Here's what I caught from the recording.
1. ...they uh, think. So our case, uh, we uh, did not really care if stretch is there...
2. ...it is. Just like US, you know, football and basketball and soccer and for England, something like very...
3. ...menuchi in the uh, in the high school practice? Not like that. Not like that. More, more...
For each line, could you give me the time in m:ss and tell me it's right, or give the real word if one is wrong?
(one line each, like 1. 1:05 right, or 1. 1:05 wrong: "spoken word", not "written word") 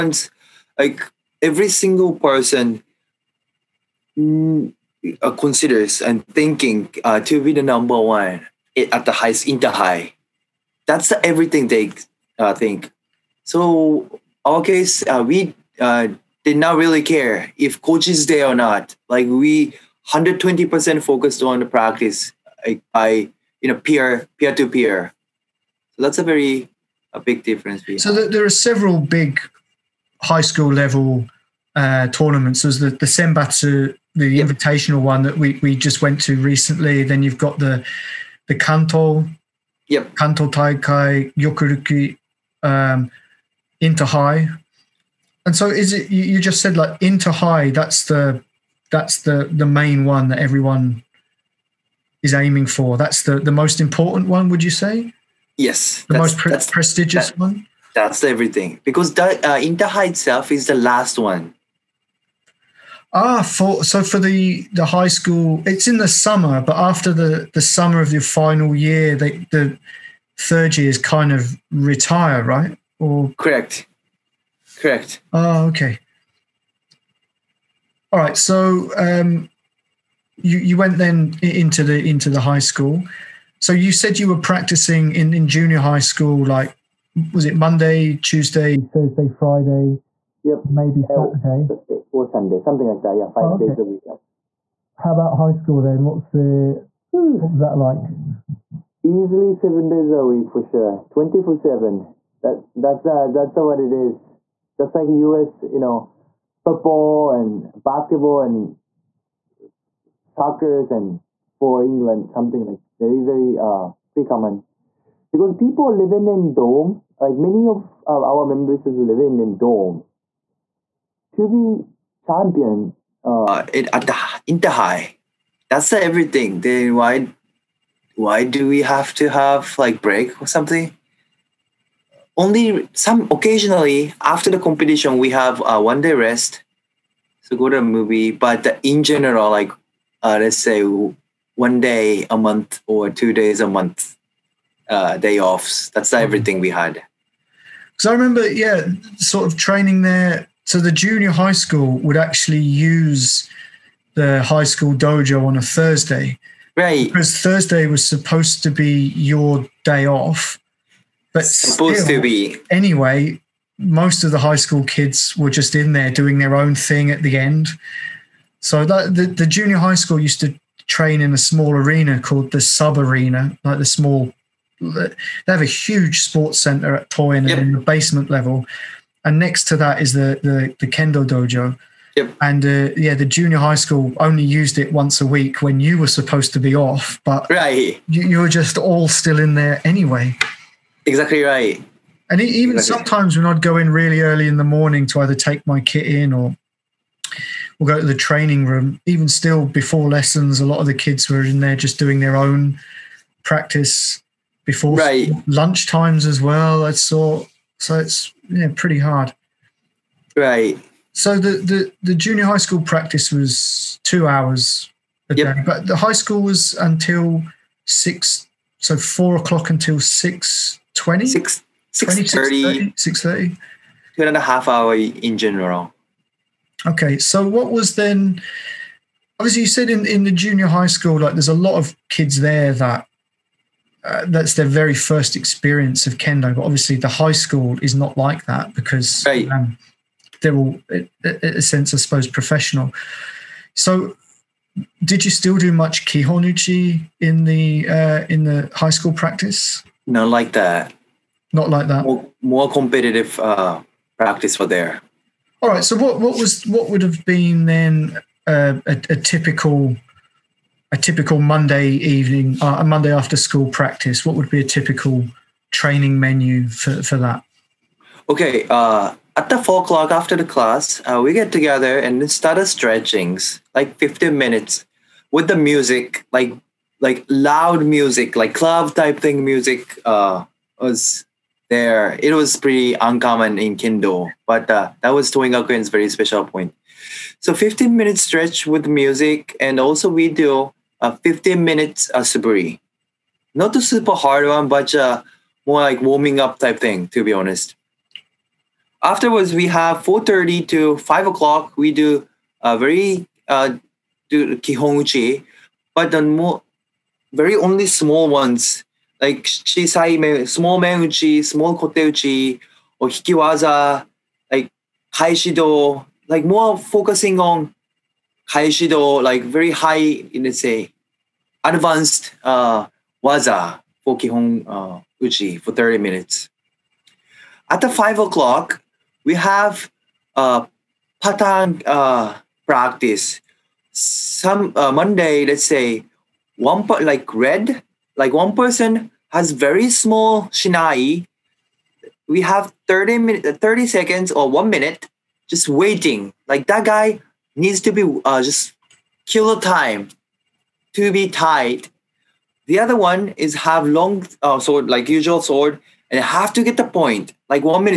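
1. 0:11 wrong: "coach", not "stretch"
2. 1:43 right
3. 4:06 wrong: "kihonuchi", not "menuchi".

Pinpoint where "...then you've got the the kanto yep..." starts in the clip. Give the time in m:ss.
0:37.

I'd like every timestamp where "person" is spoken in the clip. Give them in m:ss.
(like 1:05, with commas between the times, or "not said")
0:02, 5:38.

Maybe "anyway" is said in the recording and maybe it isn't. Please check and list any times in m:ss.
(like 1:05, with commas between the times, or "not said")
2:42, 3:09.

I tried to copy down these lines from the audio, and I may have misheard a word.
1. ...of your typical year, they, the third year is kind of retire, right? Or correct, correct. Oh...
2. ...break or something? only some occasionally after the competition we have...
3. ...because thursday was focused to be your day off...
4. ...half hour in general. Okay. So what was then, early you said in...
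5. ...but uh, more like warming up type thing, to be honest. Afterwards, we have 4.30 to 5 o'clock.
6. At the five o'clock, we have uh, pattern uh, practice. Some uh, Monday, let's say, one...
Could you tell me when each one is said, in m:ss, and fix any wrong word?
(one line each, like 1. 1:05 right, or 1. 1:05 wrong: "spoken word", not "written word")
1. 1:08 wrong: "final", not "typical"
2. 2:10 right
3. 2:37 wrong: "supposed", not "focused"
4. 3:44 wrong: "obviously", not "early"
5. 4:54 right
6. 5:27 right.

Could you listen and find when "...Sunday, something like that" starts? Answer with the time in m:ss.
1:32.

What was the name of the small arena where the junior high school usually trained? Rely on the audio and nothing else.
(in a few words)
sub arena.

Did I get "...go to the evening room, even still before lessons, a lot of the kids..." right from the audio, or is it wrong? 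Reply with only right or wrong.
wrong.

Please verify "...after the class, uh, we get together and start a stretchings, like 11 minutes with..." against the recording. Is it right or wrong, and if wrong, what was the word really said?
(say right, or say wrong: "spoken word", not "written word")
wrong: "15", not "11".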